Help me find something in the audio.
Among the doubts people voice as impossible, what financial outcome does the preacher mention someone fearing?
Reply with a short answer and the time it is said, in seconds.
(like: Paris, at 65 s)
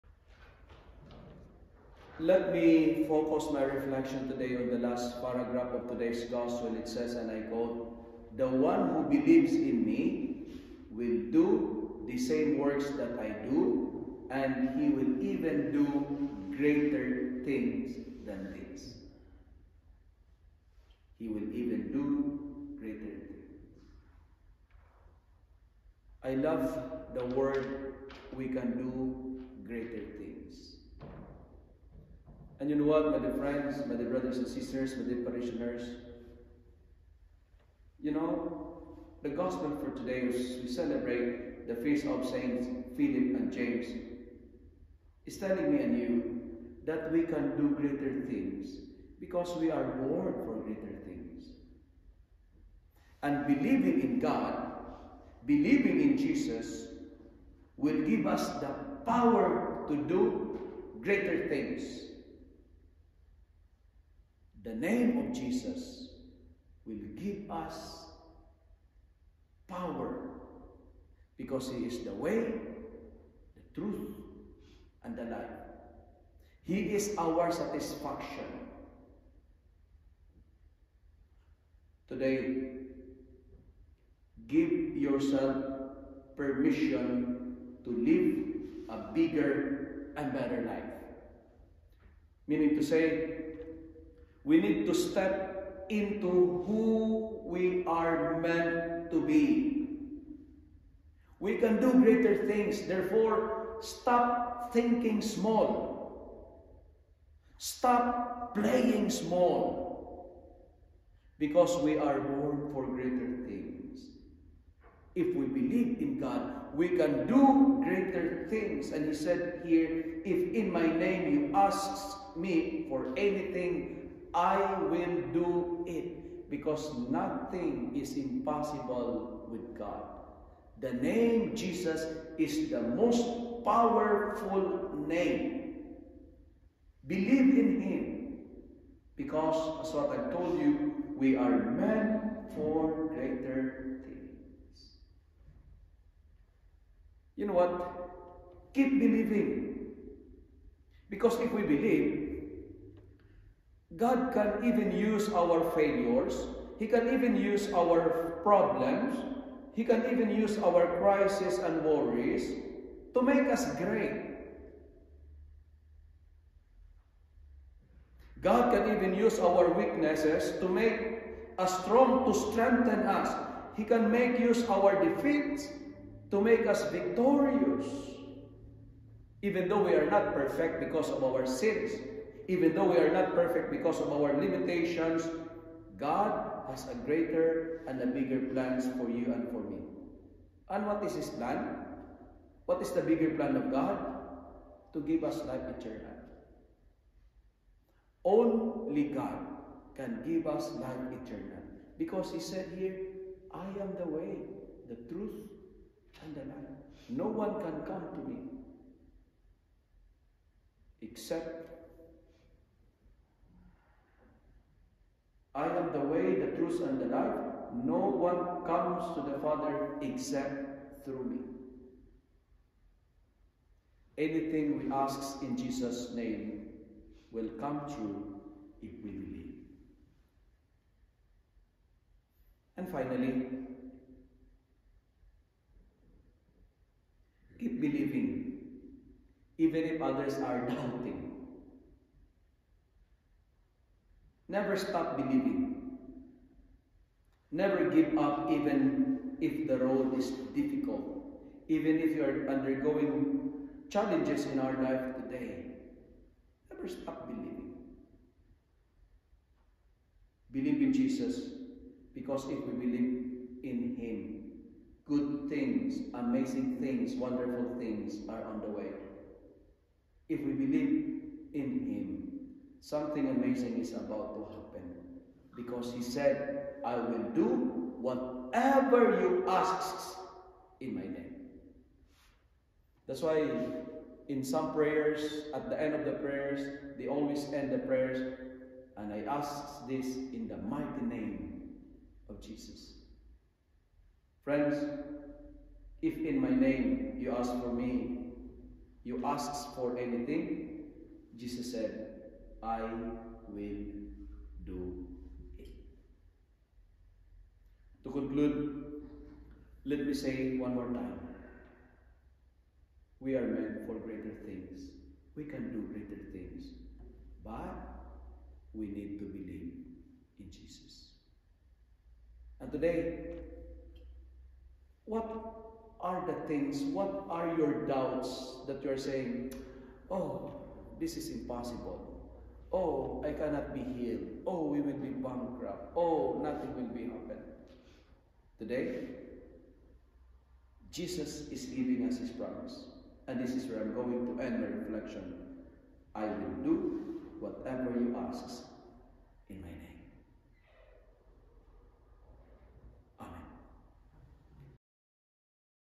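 Bankrupt, at 335 s.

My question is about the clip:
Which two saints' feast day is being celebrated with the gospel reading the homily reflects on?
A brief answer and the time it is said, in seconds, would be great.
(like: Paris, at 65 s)
Philip and James, at 42 s.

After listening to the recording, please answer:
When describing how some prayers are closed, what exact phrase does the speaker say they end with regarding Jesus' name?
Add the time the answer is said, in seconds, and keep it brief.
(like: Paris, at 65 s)
In the mighty name of Jesus, at 290 s.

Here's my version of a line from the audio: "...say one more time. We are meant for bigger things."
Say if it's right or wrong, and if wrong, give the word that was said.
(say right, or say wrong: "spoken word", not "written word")
wrong: "greater", not "bigger".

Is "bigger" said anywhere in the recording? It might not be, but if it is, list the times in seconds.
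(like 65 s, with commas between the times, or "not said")
89 s, 188 s, 193 s.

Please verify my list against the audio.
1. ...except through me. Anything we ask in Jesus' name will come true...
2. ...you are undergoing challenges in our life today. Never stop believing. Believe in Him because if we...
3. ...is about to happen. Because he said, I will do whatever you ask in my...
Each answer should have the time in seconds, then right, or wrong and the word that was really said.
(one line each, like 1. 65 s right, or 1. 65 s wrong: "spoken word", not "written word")
1. 220 s right
2. 252 s wrong: "Jesus", not "Him"
3. 273 s right.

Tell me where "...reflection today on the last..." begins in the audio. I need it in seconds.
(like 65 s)
3 s.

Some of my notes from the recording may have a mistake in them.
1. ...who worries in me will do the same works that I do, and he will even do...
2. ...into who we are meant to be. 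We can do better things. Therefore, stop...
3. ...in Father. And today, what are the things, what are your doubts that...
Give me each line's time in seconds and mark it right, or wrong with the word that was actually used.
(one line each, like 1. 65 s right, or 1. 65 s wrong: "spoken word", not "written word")
1. 8 s wrong: "believes", not "worries"
2. 95 s wrong: "greater", not "better"
3. 320 s wrong: "Jesus", not "Father".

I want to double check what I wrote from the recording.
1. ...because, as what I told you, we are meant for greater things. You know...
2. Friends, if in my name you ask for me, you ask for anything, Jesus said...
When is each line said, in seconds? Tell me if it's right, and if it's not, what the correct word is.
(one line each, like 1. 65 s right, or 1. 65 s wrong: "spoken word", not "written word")
1. 139 s right
2. 294 s right.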